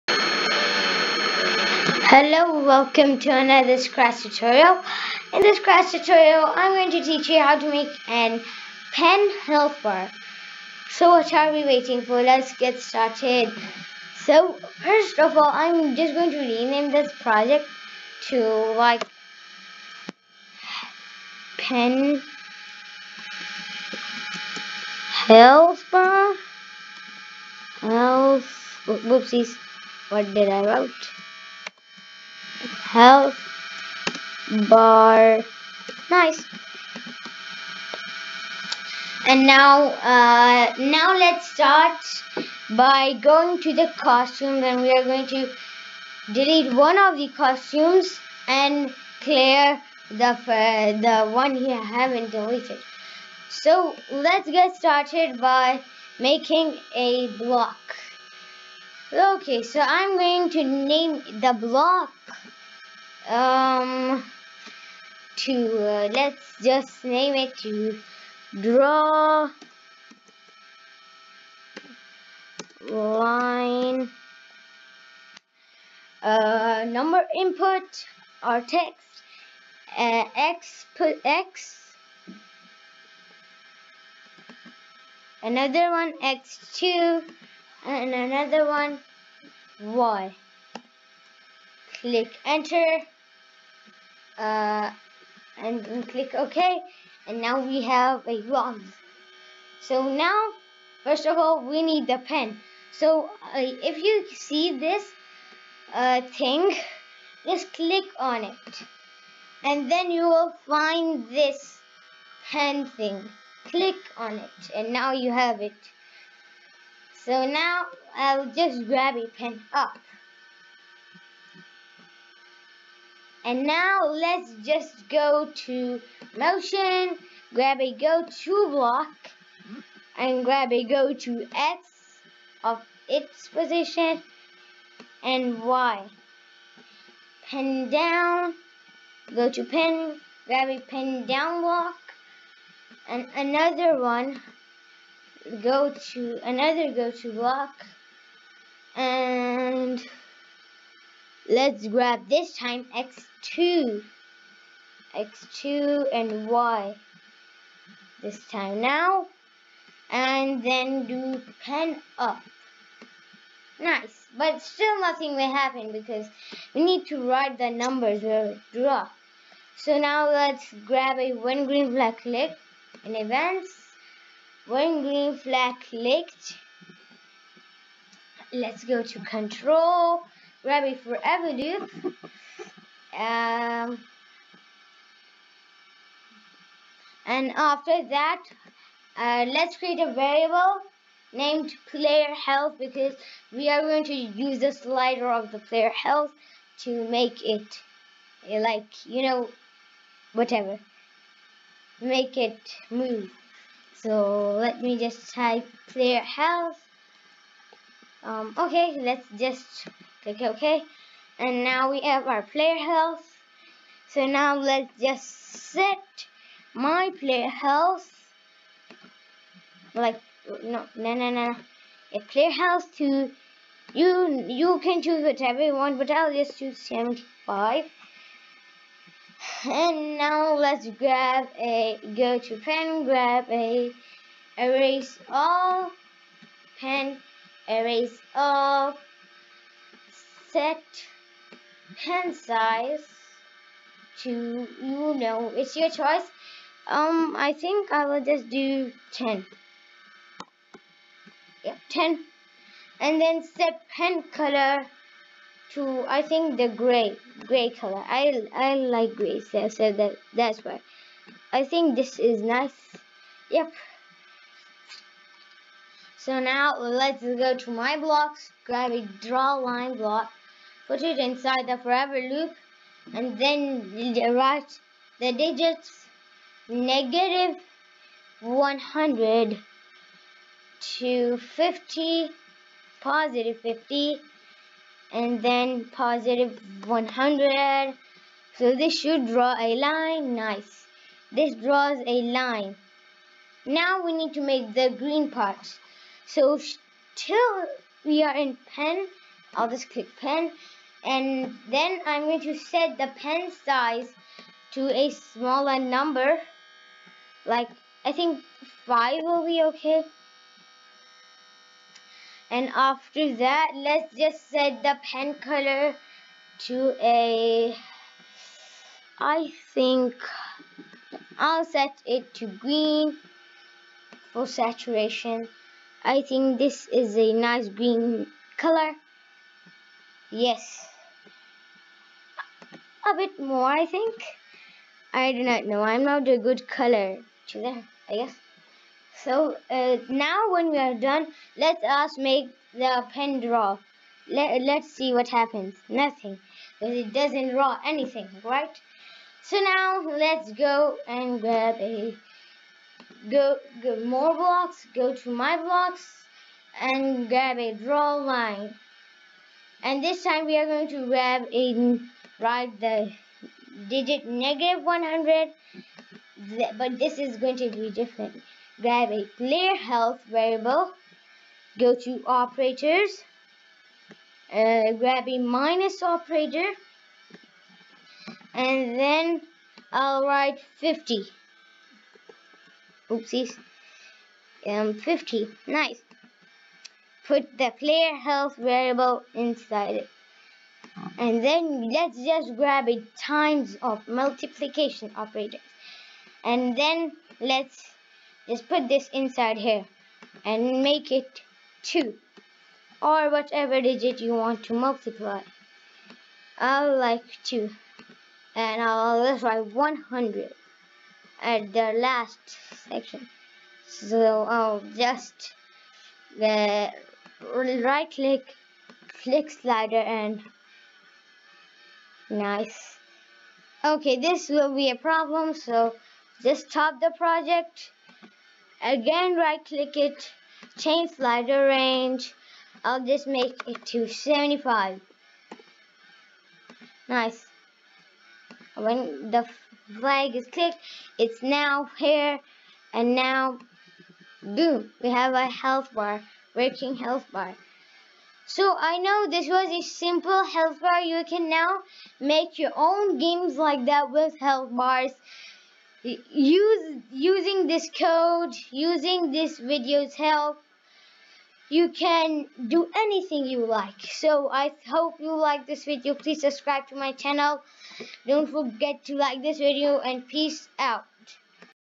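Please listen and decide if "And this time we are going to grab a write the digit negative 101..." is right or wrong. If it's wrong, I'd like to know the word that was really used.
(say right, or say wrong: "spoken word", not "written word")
wrong: "100", not "101".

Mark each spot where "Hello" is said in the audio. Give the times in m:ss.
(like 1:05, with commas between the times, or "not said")
0:02.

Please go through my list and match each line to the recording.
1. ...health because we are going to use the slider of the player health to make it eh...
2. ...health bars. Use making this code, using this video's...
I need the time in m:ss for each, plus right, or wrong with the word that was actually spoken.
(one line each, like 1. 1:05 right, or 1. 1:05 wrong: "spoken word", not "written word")
1. 3:12 right
2. 7:34 wrong: "using", not "making".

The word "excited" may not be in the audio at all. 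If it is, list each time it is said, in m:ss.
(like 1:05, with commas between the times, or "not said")
not said.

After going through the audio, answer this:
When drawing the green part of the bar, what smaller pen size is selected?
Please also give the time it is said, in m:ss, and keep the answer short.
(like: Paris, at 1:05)
5, at 5:08.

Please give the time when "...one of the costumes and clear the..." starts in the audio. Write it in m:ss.
0:46.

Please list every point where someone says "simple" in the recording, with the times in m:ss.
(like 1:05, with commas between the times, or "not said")
7:29.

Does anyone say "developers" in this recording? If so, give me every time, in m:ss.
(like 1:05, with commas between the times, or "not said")
not said.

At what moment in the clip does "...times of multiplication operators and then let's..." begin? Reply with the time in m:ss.
6:33.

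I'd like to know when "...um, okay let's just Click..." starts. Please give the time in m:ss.
3:28.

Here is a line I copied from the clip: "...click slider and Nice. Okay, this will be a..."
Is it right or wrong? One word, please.
right.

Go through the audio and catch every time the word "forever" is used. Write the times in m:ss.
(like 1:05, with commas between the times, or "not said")
3:00, 4:31.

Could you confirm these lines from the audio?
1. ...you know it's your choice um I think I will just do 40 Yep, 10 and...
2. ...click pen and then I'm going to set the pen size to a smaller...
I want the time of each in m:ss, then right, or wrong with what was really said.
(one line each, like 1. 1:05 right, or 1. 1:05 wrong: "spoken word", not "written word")
1. 4:04 wrong: "10", not "40"
2. 4:59 right.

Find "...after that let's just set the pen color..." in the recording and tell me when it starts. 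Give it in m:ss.
5:12.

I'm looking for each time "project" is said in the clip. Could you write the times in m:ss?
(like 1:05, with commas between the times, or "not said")
0:17, 7:07.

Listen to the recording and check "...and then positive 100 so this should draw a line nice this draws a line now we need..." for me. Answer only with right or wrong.
right.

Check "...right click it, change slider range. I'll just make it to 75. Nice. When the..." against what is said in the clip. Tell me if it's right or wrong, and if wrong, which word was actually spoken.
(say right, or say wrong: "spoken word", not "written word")
right.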